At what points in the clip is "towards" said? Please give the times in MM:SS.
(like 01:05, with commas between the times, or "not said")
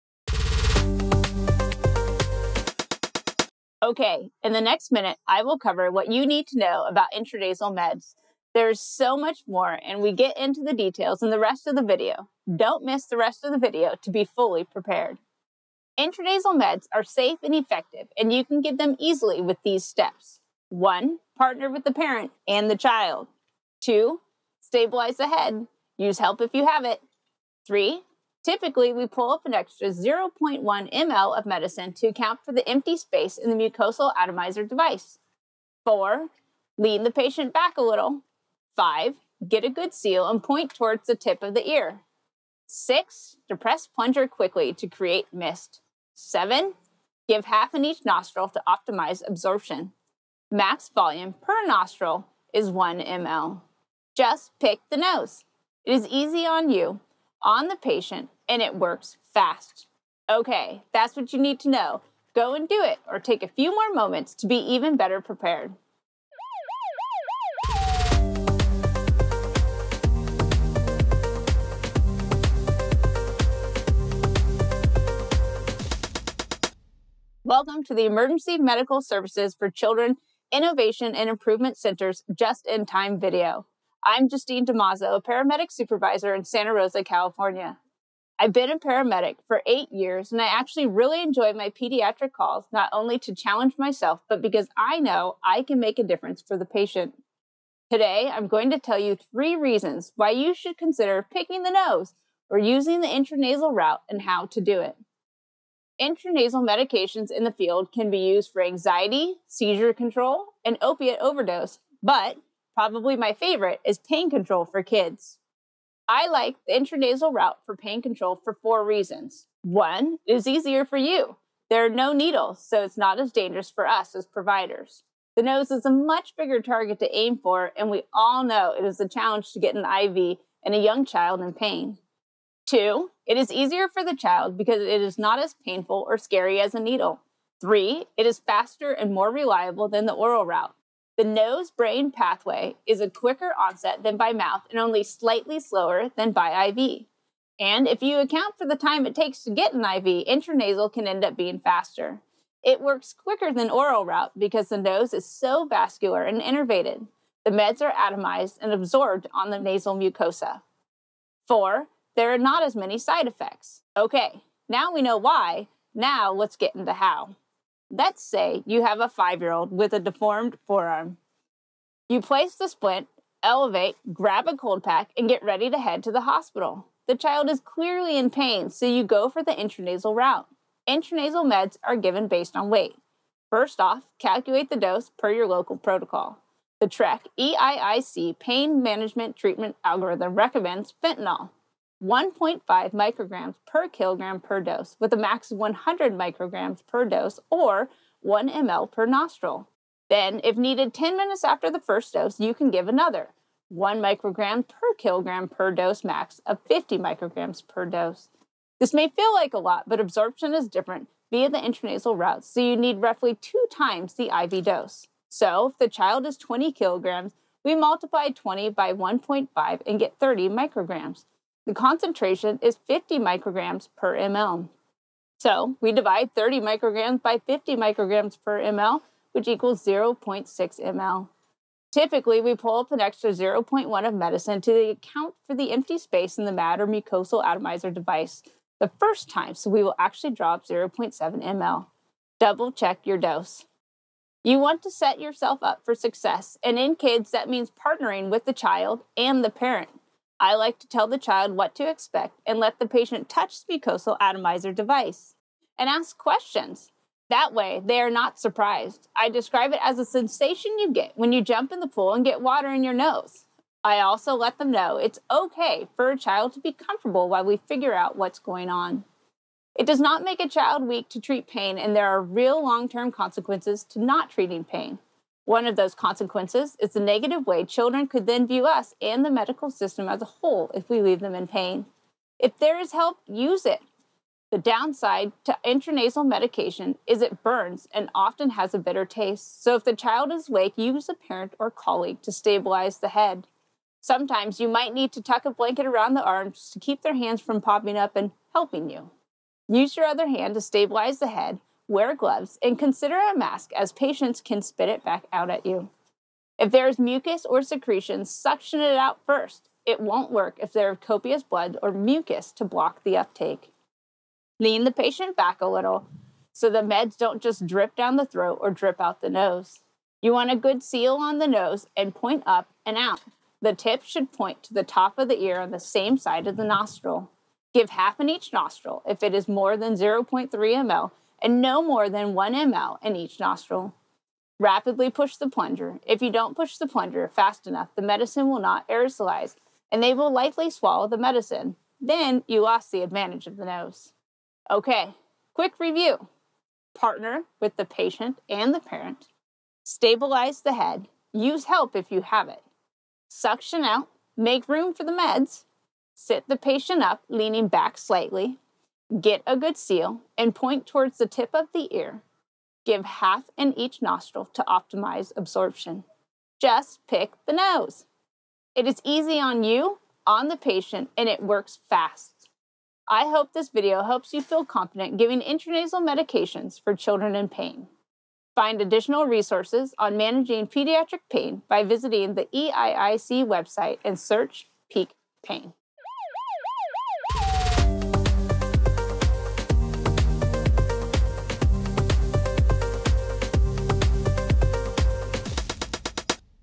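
00:40, 06:00.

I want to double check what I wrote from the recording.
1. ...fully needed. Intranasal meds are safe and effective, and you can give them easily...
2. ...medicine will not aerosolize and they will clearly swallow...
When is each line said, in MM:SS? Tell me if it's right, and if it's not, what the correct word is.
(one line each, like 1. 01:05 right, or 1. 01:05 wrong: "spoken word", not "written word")
1. 00:14 wrong: "prepared", not "needed"
2. 05:38 wrong: "likely", not "clearly".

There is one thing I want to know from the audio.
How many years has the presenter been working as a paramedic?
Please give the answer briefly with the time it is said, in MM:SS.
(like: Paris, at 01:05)
8 years, at 01:29.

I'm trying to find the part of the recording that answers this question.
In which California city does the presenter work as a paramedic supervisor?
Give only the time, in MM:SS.
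01:26.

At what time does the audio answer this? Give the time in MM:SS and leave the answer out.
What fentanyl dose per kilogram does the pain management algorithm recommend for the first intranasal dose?
03:12.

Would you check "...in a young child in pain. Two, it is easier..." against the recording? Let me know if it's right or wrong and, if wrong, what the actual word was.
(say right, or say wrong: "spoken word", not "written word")
right.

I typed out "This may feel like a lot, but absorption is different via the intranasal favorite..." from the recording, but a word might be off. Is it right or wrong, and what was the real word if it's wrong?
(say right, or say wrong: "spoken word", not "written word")
wrong: "route", not "favorite".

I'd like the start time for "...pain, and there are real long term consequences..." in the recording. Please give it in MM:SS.
04:31.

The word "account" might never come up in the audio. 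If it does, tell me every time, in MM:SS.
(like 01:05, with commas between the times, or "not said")
00:32, 02:28, 03:54.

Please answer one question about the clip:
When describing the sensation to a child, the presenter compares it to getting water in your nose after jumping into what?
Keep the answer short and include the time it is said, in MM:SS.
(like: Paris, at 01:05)
the pool, at 04:21.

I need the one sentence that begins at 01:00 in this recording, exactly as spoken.
Okay, that's what you need to know.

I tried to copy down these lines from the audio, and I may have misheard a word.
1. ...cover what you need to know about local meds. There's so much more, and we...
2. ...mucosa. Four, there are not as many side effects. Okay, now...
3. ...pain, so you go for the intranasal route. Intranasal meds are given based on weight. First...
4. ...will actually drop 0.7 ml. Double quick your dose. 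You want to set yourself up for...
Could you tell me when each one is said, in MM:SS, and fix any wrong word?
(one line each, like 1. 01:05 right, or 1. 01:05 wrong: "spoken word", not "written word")
1. 00:05 wrong: "intranasal", not "local"
2. 02:39 right
3. 02:58 right
4. 03:59 wrong: "check", not "quick".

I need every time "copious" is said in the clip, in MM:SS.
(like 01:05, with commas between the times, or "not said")
05:11.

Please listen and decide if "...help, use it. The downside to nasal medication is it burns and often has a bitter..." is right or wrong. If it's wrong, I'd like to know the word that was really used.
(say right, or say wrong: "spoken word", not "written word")
wrong: "intranasal", not "nasal".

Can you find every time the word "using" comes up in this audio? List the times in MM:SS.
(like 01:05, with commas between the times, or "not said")
01:42.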